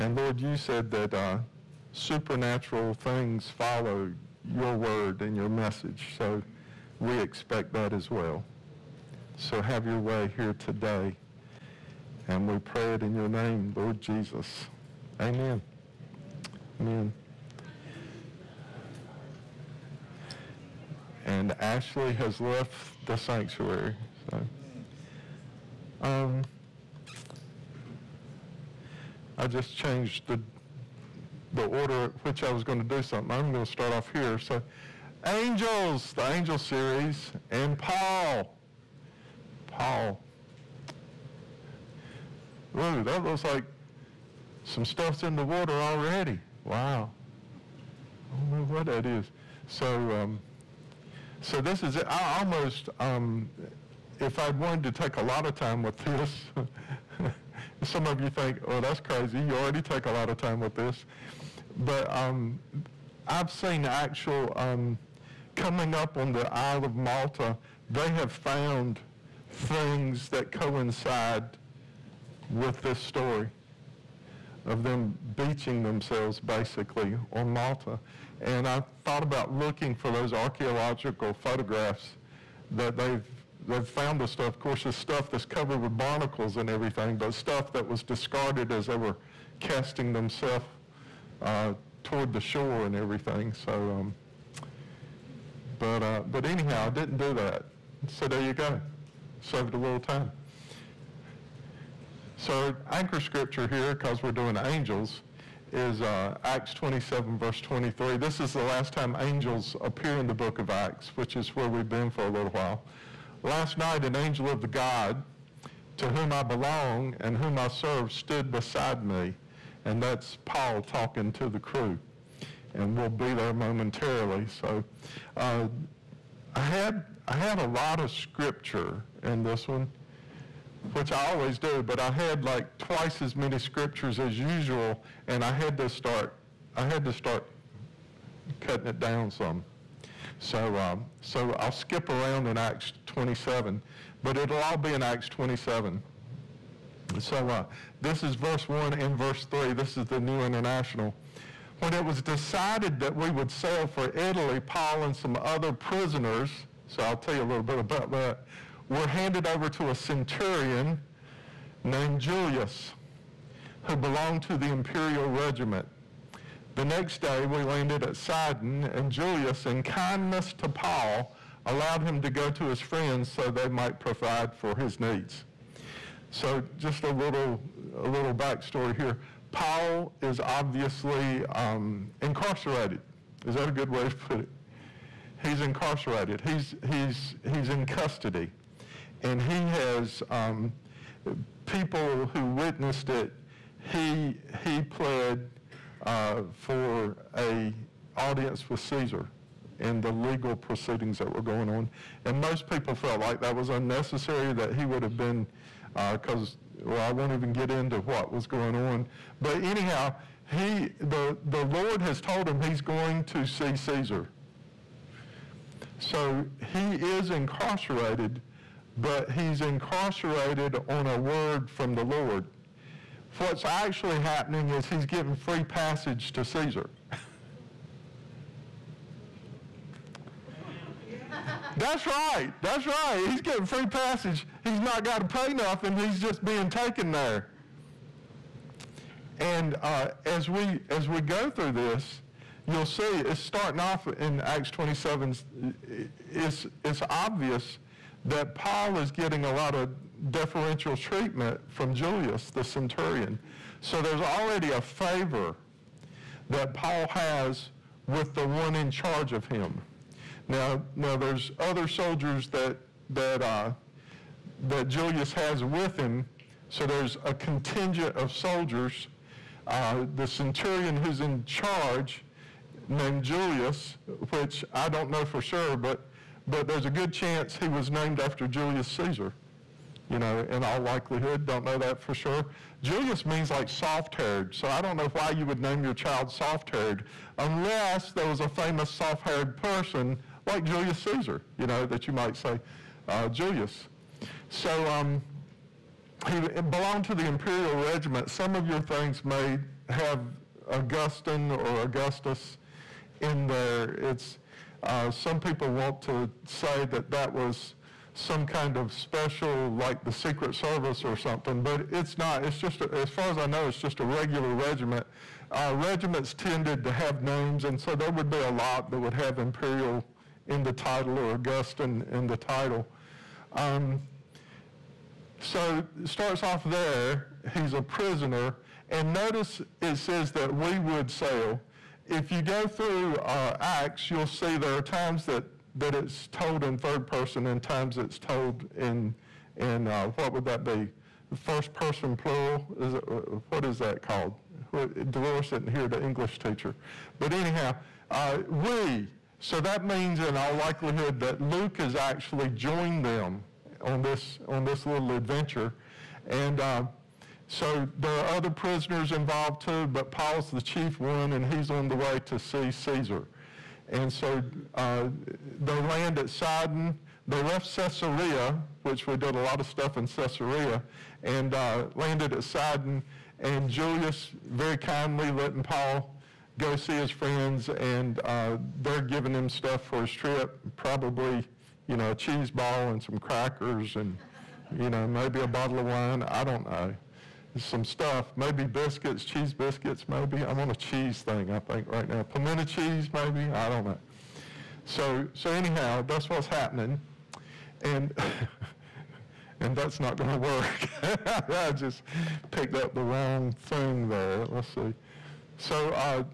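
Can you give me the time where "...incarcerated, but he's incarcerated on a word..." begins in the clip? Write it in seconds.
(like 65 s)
217 s.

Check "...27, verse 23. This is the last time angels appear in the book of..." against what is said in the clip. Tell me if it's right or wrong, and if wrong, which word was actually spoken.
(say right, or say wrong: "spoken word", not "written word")
right.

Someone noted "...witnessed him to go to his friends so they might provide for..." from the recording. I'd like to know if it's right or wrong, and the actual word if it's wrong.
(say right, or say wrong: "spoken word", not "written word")
wrong: "allowed", not "witnessed".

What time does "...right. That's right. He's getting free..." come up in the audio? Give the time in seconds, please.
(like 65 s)
232 s.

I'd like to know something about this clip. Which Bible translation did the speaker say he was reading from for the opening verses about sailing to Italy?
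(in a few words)
New International.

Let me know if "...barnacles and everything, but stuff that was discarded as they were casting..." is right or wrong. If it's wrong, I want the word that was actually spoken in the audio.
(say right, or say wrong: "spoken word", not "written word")
right.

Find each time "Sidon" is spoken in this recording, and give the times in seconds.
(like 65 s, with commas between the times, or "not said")
168 s, 366 s, 372 s.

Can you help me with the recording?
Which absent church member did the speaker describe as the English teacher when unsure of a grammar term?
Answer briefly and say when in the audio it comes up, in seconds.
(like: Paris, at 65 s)
Dolores, at 345 s.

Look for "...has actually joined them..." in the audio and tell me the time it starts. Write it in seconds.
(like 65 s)
351 s.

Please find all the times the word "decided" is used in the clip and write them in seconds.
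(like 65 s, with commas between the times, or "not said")
152 s.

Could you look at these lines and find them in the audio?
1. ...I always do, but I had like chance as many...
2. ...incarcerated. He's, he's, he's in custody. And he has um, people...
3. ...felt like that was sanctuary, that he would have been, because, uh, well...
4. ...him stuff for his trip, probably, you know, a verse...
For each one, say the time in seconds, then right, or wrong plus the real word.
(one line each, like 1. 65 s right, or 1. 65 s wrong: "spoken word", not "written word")
1. 131 s wrong: "twice", not "chance"
2. 185 s right
3. 202 s wrong: "unnecessary", not "sanctuary"
4. 379 s wrong: "cheese", not "verse".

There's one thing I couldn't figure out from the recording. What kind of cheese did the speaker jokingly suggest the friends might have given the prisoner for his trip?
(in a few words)
Pimento cheese.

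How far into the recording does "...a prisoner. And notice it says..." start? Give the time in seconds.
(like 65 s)
327 s.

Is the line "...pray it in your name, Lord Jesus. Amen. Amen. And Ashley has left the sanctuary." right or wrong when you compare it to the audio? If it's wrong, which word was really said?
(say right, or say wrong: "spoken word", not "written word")
right.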